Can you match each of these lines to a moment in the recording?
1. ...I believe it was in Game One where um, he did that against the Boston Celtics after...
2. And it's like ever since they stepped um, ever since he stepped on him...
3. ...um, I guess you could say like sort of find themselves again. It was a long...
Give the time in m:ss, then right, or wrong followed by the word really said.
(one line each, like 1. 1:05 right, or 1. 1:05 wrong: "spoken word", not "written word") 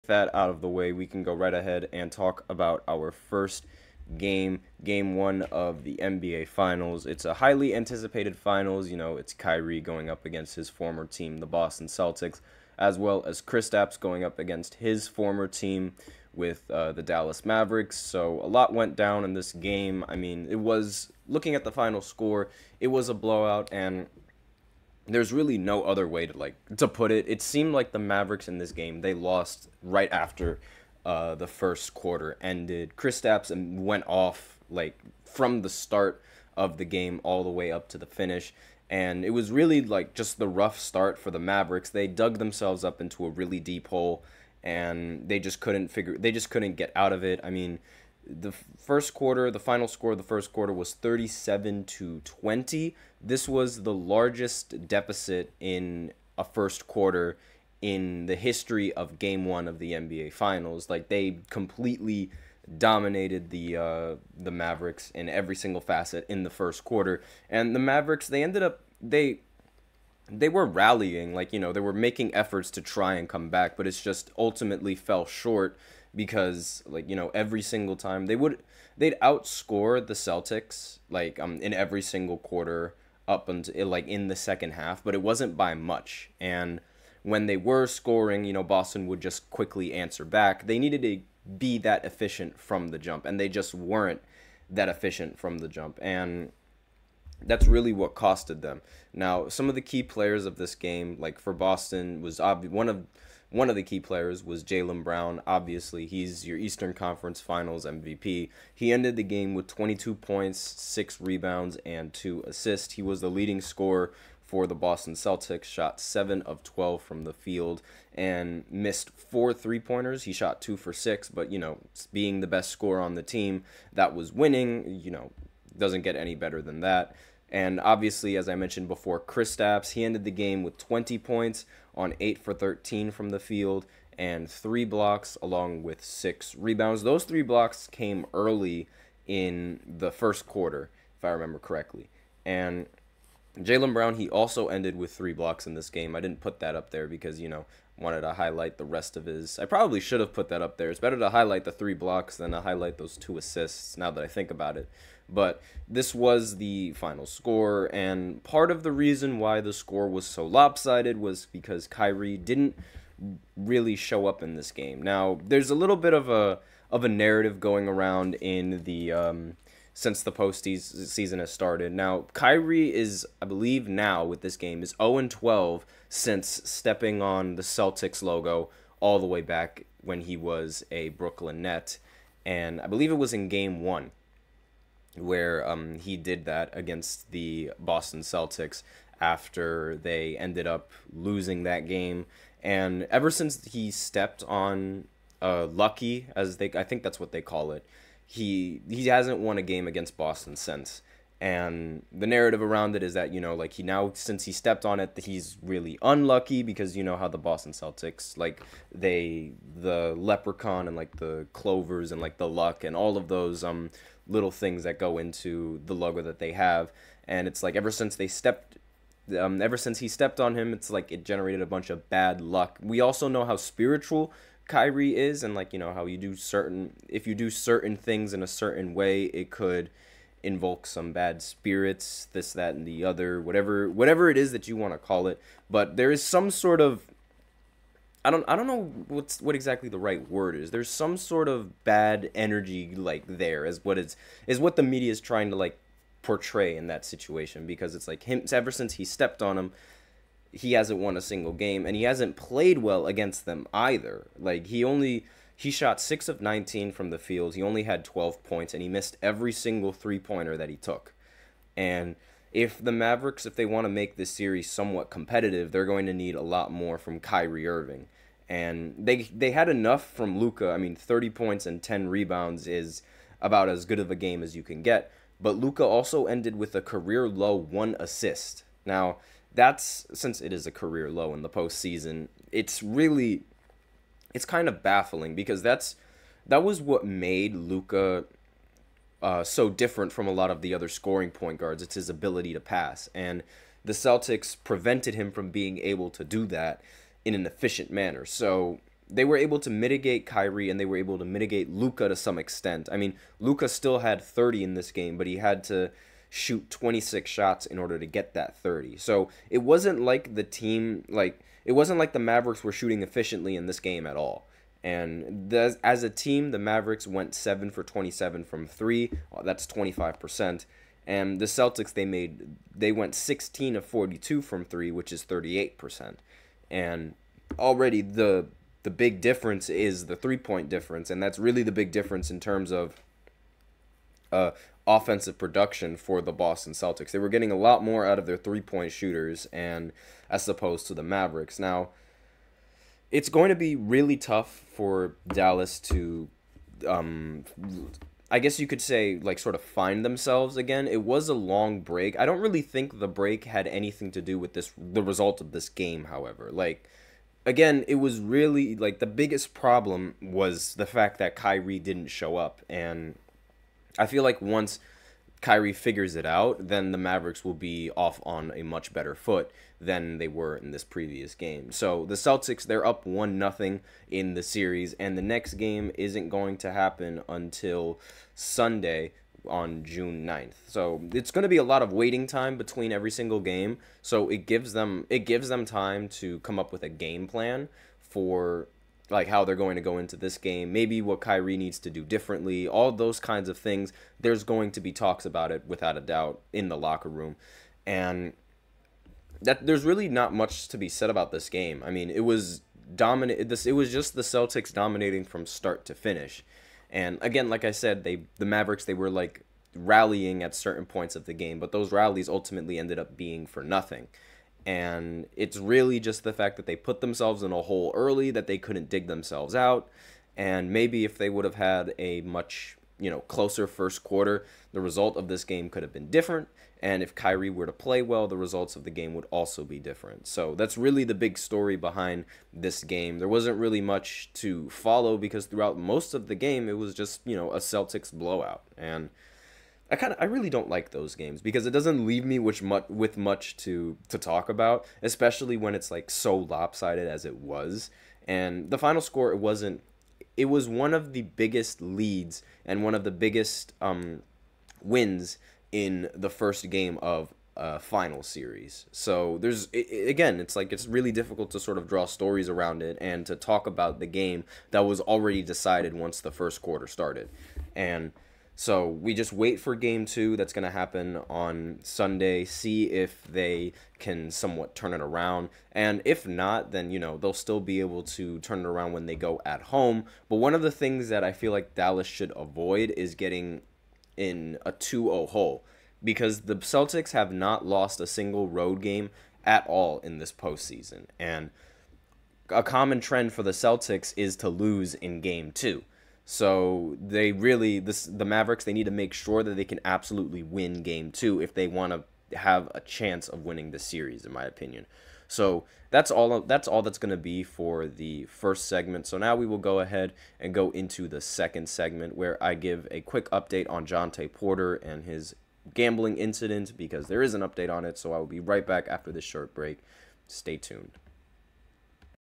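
1. 3:02 right
2. 3:37 right
3. 5:46 right.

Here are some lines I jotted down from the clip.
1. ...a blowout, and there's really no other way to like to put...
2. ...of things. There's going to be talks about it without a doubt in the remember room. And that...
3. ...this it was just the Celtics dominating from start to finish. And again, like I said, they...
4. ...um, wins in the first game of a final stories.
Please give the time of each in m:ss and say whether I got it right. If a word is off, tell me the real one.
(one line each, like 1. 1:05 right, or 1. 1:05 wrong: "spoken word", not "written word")
1. 0:23 right
2. 6:33 wrong: "locker", not "remember"
3. 6:43 right
4. 7:33 wrong: "series", not "stories".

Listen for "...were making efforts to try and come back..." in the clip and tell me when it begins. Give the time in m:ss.
1:11.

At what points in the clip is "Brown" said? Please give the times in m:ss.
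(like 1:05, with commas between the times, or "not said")
1:45, 2:23.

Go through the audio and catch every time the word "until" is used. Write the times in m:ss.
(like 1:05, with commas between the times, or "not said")
1:23, 6:17.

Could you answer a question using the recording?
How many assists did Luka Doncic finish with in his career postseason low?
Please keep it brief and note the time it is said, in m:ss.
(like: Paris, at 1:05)
1 assist, at 4:37.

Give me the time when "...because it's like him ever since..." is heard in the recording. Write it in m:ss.
4:07.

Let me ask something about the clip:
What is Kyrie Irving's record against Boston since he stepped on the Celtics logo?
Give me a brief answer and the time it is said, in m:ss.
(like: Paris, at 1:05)
0-12, at 2:54.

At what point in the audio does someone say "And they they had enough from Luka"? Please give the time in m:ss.
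4:28.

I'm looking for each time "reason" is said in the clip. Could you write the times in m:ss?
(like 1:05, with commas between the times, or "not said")
2:38.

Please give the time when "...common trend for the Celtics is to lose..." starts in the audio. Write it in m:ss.
8:12.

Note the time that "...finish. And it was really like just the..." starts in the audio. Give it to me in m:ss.
0:38.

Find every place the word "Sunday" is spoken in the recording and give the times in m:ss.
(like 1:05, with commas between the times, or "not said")
6:18, 7:51.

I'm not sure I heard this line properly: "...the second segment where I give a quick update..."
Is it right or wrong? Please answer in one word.
right.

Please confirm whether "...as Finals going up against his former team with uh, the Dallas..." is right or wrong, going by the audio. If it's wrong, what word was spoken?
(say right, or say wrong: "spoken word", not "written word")
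wrong: "Kristaps", not "Finals".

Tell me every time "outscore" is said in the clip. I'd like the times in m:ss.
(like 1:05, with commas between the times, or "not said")
1:19.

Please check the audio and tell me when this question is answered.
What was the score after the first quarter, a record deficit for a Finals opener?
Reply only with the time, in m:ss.
0:50.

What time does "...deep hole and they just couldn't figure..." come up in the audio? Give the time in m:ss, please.
0:43.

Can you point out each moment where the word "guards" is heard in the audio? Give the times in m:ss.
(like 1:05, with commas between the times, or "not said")
4:51.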